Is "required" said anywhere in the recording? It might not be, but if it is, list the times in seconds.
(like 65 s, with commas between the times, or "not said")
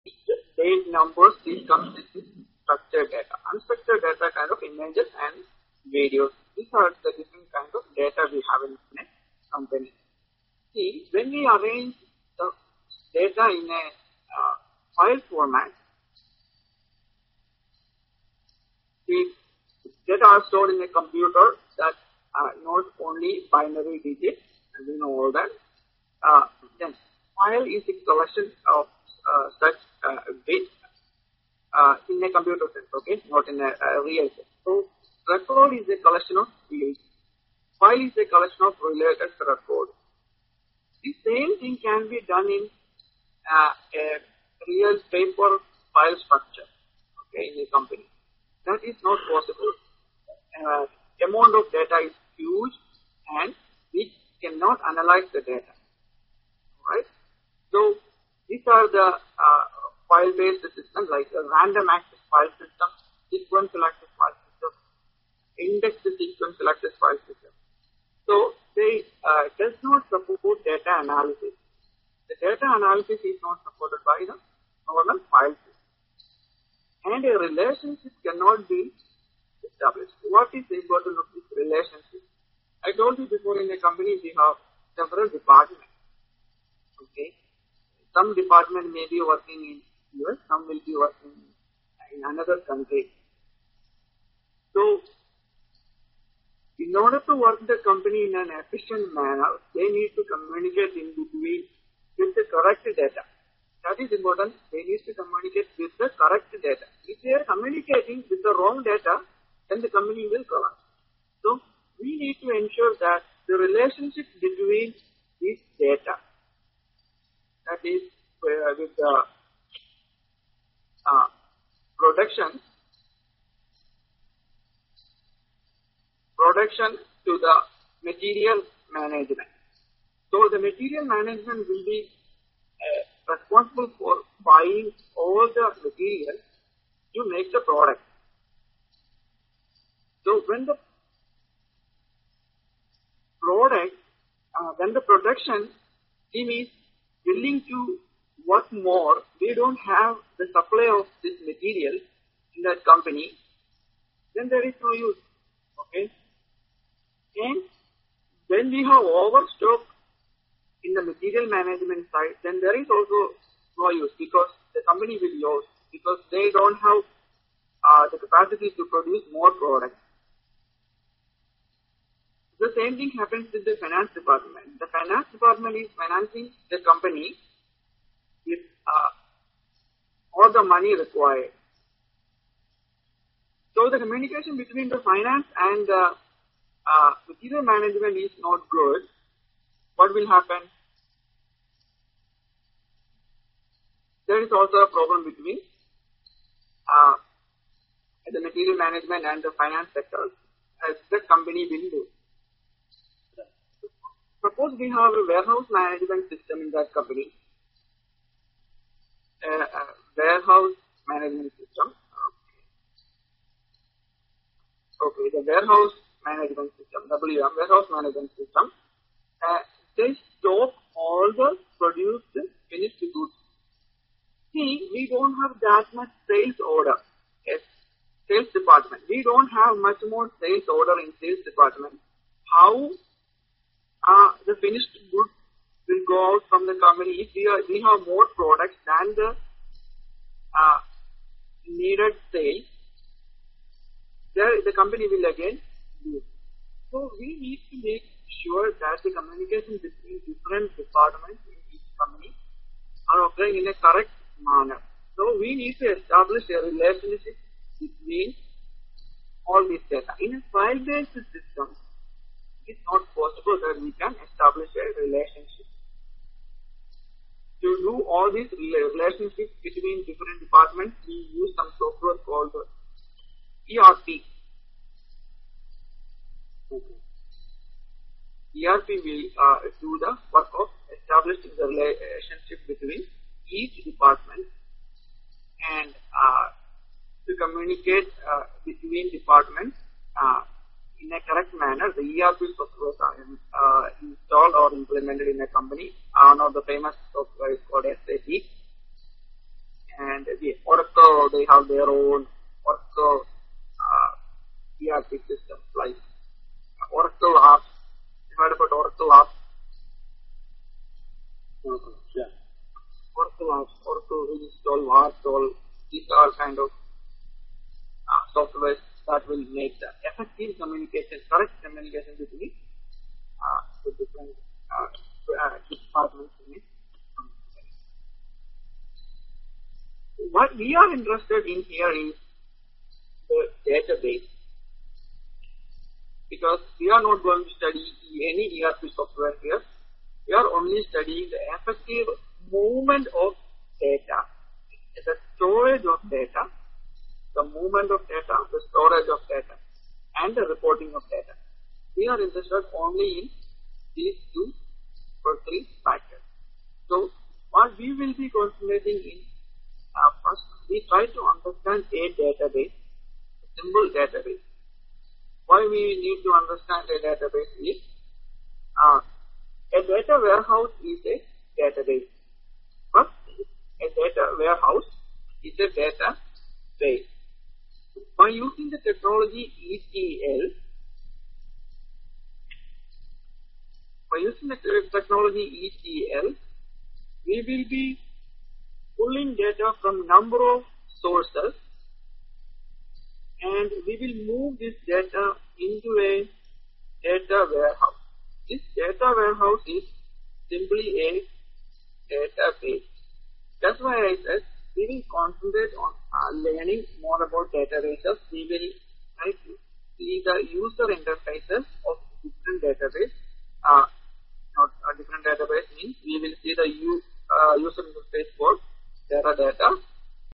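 180 s.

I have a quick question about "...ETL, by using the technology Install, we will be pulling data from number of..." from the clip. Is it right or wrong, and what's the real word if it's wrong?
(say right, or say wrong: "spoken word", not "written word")
wrong: "ETL", not "Install".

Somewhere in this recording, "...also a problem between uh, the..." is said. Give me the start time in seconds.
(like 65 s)
194 s.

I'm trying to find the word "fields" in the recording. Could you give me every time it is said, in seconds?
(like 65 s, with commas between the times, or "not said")
36 s.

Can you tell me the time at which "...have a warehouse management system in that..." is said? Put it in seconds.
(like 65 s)
204 s.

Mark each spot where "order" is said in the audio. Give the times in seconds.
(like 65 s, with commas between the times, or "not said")
96 s, 226 s, 230 s.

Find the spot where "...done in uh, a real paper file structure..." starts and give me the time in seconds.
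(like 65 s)
42 s.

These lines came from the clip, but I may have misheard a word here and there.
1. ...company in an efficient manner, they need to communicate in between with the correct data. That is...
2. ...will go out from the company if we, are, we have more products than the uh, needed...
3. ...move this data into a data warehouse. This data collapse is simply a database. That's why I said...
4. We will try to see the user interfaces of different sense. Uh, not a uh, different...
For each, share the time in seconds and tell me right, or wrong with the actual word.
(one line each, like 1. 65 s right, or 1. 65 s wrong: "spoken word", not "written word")
1. 97 s right
2. 235 s right
3. 394 s wrong: "warehouse", not "collapse"
4. 408 s wrong: "database", not "sense".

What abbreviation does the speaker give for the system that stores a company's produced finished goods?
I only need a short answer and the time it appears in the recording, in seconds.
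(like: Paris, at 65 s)
WM, at 217 s.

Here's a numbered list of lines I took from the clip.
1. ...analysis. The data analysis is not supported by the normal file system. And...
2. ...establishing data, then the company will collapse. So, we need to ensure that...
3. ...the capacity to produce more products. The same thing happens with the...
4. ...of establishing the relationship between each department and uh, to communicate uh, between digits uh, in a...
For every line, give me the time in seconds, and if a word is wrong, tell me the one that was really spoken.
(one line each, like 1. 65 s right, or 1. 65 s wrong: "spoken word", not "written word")
1. 70 s right
2. 108 s wrong: "wrong", not "establishing"
3. 168 s right
4. 280 s wrong: "departments", not "digits".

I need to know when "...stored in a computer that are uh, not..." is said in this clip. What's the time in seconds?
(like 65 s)
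20 s.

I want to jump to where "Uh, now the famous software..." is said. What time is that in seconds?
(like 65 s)
296 s.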